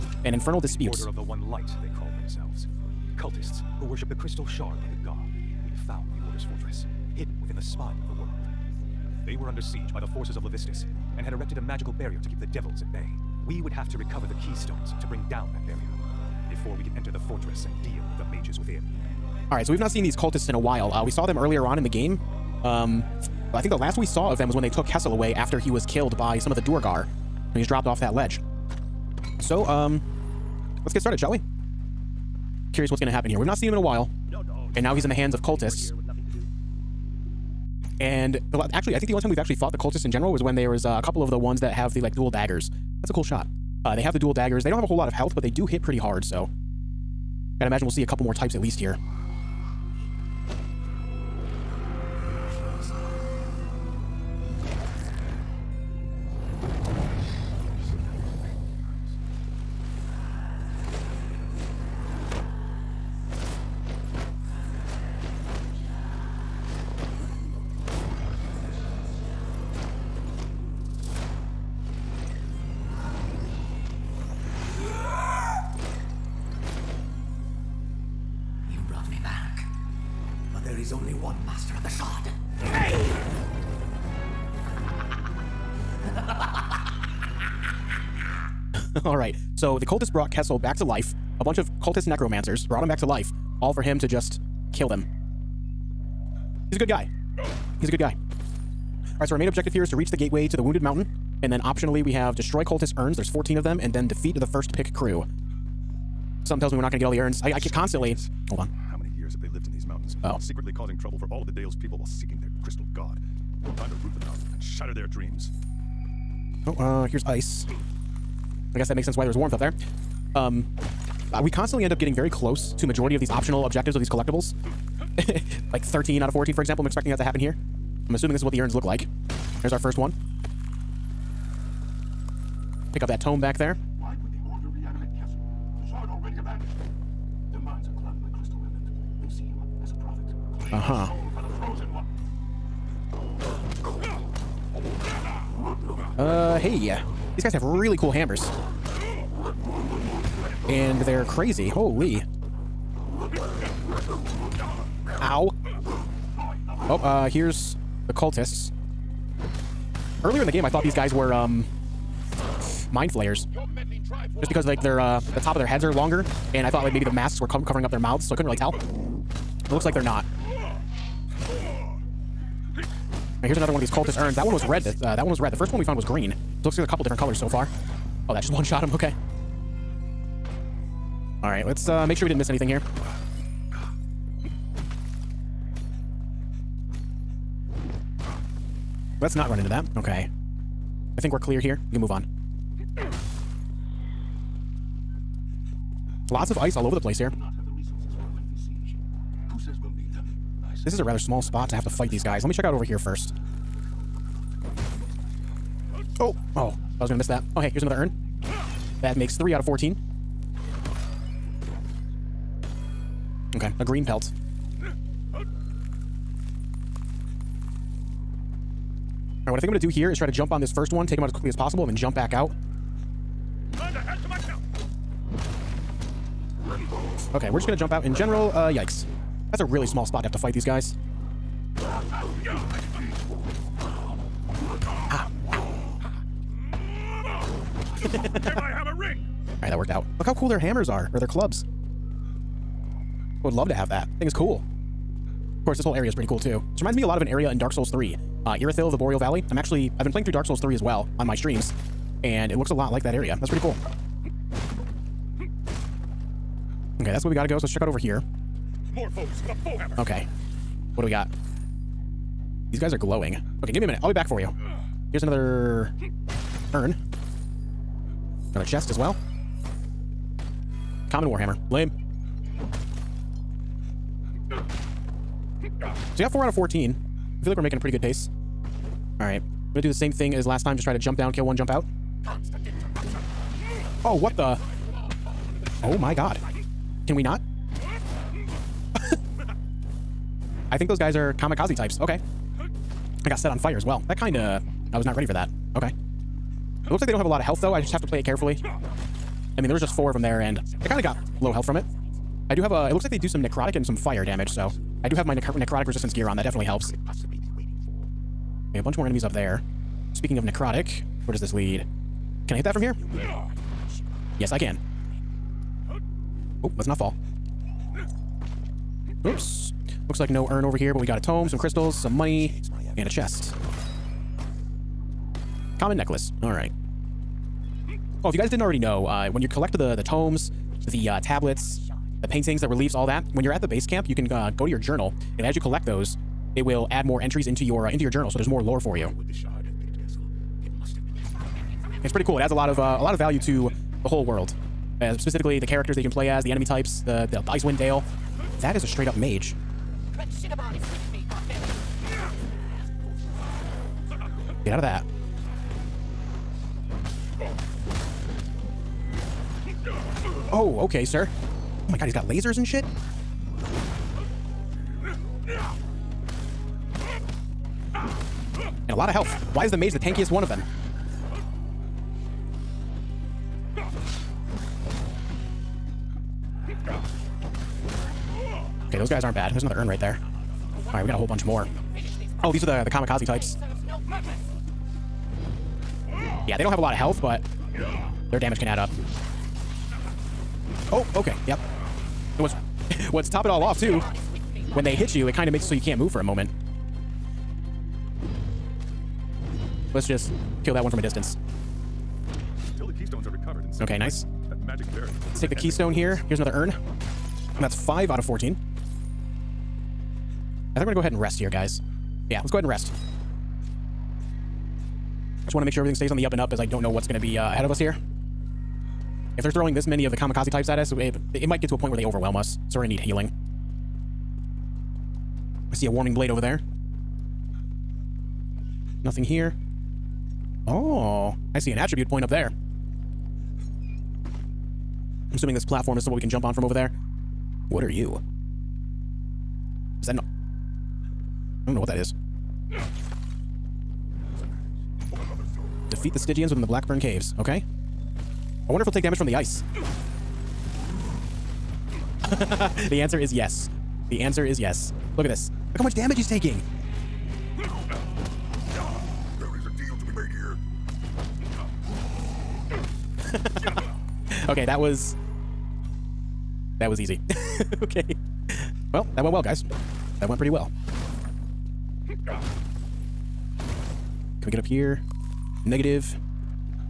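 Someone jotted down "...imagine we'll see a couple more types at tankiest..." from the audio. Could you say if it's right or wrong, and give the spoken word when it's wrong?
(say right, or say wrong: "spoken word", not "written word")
wrong: "least", not "tankiest".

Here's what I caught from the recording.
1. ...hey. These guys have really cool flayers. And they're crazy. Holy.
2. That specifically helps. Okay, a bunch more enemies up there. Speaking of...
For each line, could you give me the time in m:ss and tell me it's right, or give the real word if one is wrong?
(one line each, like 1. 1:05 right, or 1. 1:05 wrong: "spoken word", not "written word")
1. 2:26 wrong: "hammers", not "flayers"
2. 5:06 wrong: "definitely", not "specifically".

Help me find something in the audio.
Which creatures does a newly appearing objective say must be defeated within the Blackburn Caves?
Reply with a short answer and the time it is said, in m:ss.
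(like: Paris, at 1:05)
Stygians, at 7:26.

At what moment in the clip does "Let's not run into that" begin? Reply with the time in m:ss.
3:09.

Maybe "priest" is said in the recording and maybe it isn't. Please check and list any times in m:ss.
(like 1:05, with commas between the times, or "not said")
not said.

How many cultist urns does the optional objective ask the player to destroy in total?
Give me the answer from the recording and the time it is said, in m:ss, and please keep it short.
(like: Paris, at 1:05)
14, at 1:43.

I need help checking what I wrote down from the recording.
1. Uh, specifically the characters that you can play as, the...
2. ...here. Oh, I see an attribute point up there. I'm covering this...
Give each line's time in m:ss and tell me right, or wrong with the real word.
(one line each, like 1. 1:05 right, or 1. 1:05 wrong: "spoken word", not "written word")
1. 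5:45 right
2. 7:09 wrong: "assuming", not "covering".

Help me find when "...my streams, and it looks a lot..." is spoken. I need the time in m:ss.
4:11.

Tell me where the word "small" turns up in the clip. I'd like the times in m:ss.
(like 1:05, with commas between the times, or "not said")
3:21, 3:49.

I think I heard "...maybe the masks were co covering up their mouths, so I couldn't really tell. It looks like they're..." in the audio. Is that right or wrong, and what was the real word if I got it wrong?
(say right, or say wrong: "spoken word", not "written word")
right.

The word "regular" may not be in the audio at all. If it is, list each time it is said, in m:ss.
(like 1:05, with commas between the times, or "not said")
not said.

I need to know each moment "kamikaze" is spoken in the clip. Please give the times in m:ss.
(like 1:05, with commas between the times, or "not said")
4:51, 6:22, 7:00.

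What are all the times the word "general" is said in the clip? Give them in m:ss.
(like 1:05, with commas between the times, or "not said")
0:40, 3:48.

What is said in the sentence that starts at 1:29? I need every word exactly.
So the cultists brought Kessell back to life.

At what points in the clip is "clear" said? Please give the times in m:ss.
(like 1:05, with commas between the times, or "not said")
3:11.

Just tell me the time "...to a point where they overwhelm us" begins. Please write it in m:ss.
7:01.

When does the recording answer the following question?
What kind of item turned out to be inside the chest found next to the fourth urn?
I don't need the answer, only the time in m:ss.
4:31.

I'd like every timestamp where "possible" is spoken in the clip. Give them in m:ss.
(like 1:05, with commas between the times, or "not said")
3:41.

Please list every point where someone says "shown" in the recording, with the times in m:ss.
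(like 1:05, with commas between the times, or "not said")
not said.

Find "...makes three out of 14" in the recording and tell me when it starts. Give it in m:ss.
3:29.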